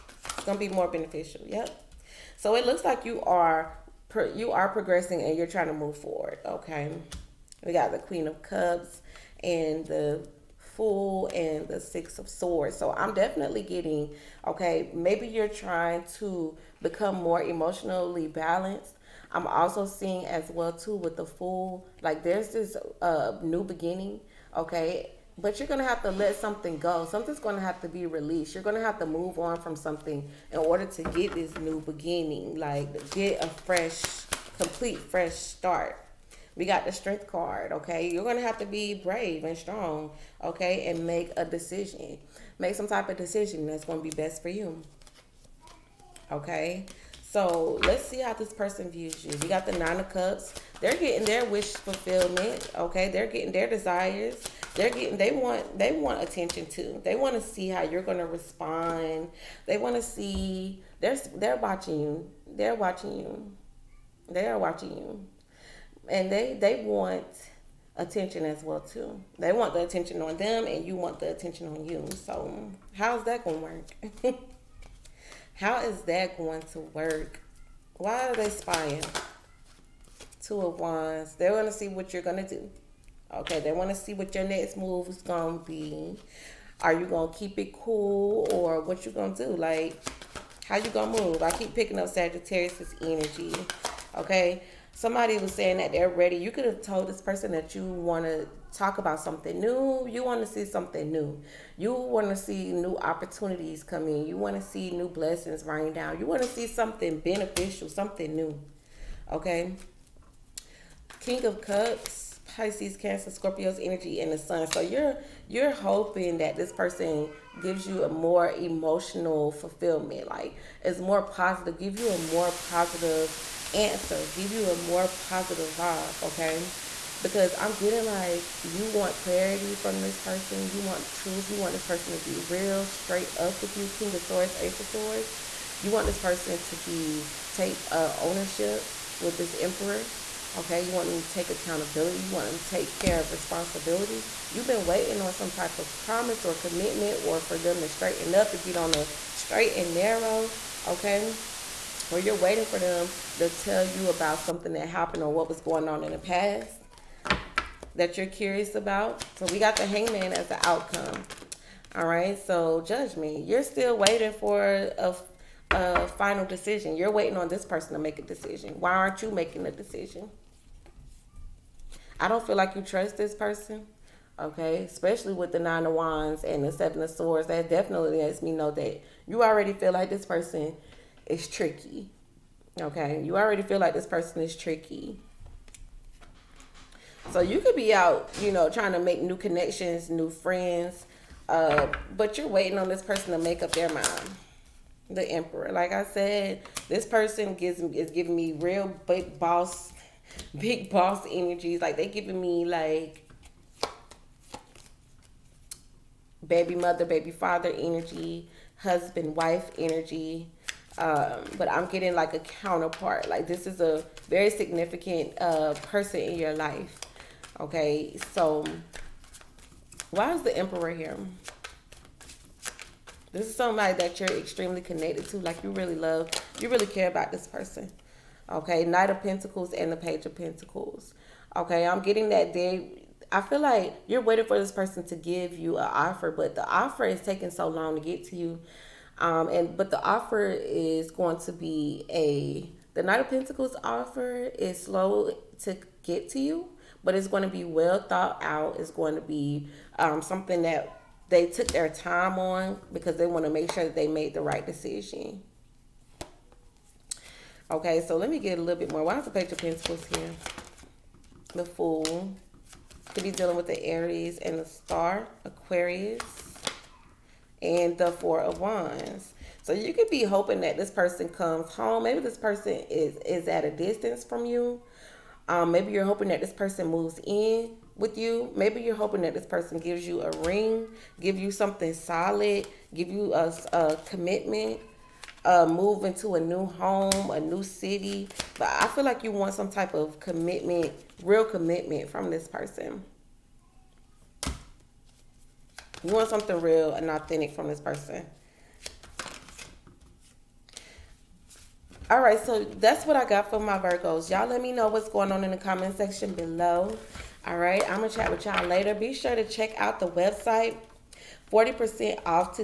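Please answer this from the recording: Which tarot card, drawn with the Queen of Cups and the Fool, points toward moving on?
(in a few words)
Six of Swords.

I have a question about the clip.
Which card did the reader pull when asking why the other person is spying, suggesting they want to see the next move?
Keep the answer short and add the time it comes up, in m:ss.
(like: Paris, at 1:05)
Two of Wands, at 1:20.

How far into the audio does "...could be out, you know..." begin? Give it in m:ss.
3:07.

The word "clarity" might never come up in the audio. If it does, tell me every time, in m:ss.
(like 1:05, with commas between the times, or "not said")
2:09.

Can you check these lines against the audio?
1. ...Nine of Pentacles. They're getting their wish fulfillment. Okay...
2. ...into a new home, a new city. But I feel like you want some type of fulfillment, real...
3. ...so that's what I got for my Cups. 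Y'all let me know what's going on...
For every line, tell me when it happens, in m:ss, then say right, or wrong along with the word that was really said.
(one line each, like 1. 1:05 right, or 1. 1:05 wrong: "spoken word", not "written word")
1. 0:49 wrong: "Cups", not "Pentacles"
2. 4:46 wrong: "commitment", not "fulfillment"
3. 5:02 wrong: "Virgos", not "Cups".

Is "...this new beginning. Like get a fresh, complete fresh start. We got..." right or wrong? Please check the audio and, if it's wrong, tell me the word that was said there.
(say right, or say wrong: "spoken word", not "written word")
right.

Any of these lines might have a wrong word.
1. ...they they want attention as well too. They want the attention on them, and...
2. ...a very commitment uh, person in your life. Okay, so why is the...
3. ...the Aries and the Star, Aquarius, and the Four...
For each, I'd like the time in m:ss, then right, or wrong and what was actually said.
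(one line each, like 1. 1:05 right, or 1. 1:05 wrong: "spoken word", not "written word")
1. 1:06 right
2. 3:33 wrong: "significant", not "commitment"
3. 4:23 right.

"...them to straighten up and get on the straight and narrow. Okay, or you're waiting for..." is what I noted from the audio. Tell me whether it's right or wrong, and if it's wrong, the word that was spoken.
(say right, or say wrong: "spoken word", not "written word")
right.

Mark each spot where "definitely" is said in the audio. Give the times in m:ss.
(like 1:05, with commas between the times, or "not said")
0:13, 2:57.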